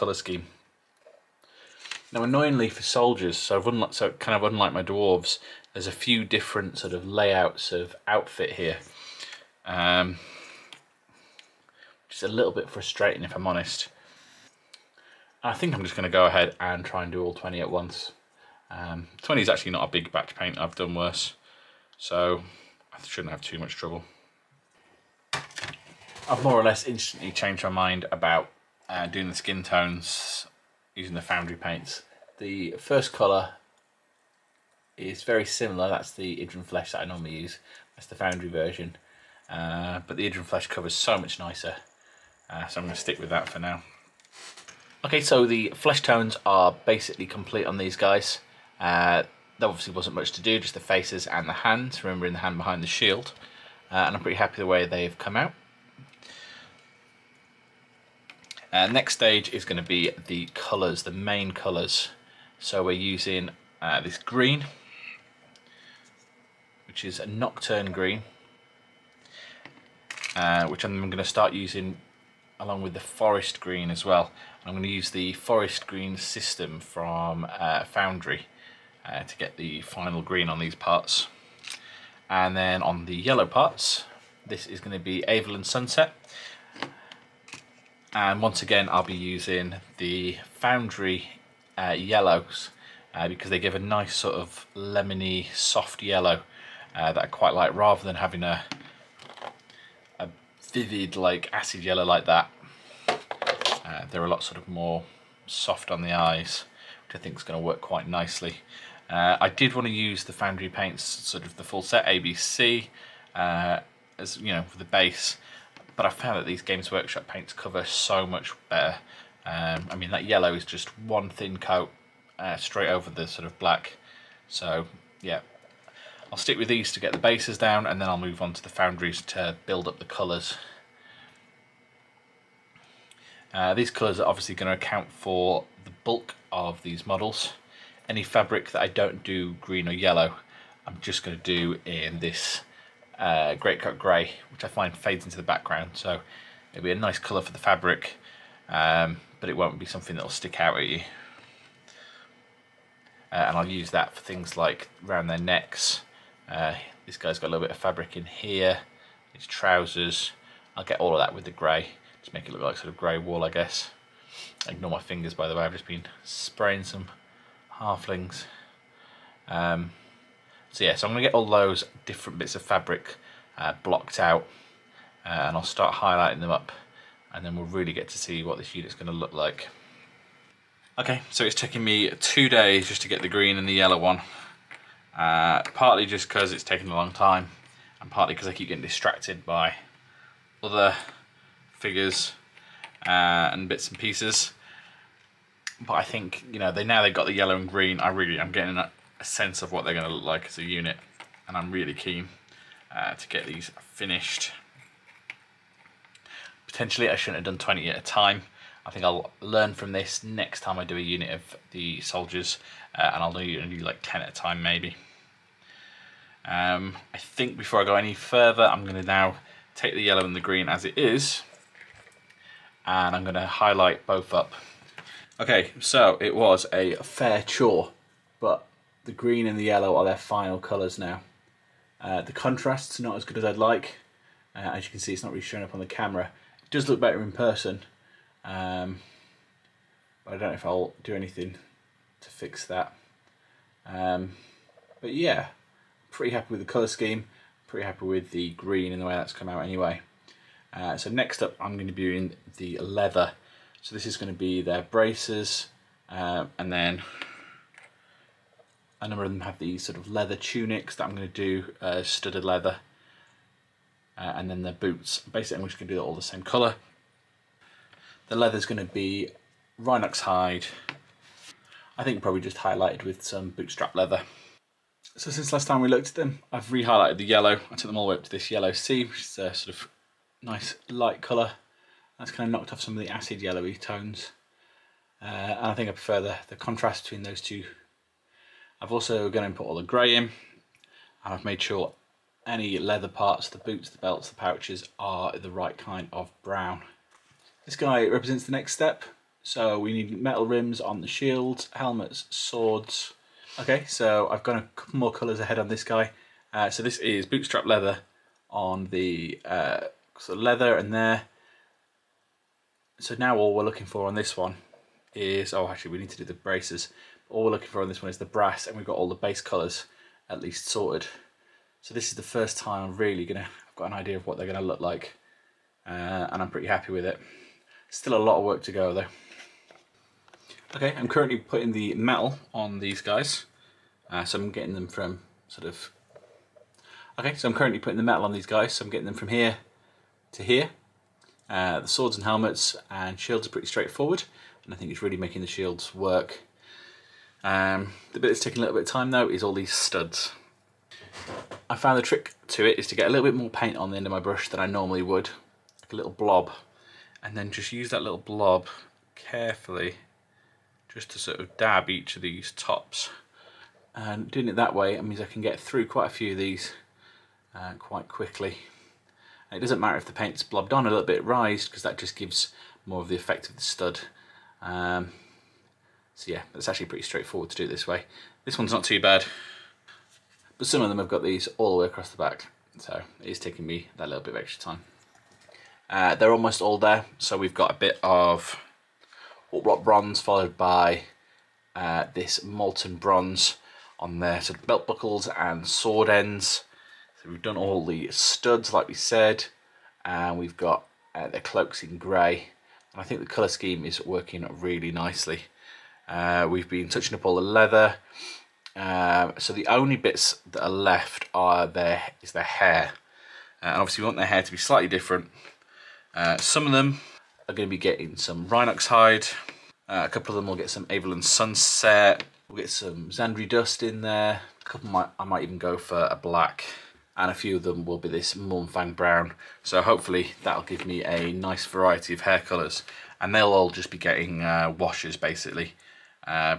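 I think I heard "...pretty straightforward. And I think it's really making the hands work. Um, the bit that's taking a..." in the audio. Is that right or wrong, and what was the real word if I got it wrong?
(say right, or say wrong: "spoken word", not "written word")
wrong: "shields", not "hands".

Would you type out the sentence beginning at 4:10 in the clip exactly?
Uh, so next up, I'm going to be in the leather.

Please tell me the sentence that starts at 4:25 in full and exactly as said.
Basically, I'm just going to do all the same colour.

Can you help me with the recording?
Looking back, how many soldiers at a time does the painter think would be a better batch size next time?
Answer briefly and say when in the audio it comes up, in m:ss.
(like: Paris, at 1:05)
10, at 3:34.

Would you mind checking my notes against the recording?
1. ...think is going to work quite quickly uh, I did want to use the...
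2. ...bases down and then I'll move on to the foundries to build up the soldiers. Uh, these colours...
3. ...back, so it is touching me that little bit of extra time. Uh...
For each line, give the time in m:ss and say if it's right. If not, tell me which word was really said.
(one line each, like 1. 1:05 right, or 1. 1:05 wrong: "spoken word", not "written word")
1. 1:47 wrong: "nicely", not "quickly"
2. 2:07 wrong: "colours", not "soldiers"
3. 6:22 wrong: "taking", not "touching".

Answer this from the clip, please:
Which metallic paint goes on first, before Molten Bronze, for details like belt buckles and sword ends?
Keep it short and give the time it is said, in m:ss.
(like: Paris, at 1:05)
Warplock Bronze, at 6:29.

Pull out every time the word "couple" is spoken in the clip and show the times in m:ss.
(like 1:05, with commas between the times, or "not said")
5:04, 7:00, 7:04.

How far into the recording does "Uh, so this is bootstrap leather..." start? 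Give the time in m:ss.
5:06.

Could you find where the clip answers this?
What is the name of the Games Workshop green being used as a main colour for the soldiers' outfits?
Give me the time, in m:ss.
1:07.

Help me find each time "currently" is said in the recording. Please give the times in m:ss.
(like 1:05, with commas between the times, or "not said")
5:31, 5:37.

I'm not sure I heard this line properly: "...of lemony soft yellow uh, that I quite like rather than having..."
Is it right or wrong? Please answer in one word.
right.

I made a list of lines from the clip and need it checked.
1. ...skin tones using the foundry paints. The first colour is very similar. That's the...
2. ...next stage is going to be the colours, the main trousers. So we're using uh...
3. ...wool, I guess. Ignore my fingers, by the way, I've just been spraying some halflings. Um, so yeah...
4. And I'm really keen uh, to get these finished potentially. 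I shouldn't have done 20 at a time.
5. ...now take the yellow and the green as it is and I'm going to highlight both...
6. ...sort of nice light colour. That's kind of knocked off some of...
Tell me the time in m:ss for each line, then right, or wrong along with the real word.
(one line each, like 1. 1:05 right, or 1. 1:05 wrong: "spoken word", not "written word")
1. 0:29 right
2. 0:58 wrong: "colours", not "trousers"
3. 2:43 right
4. 3:21 right
5. 3:39 right
6. 4:39 right.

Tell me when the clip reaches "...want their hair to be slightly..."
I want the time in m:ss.
6:54.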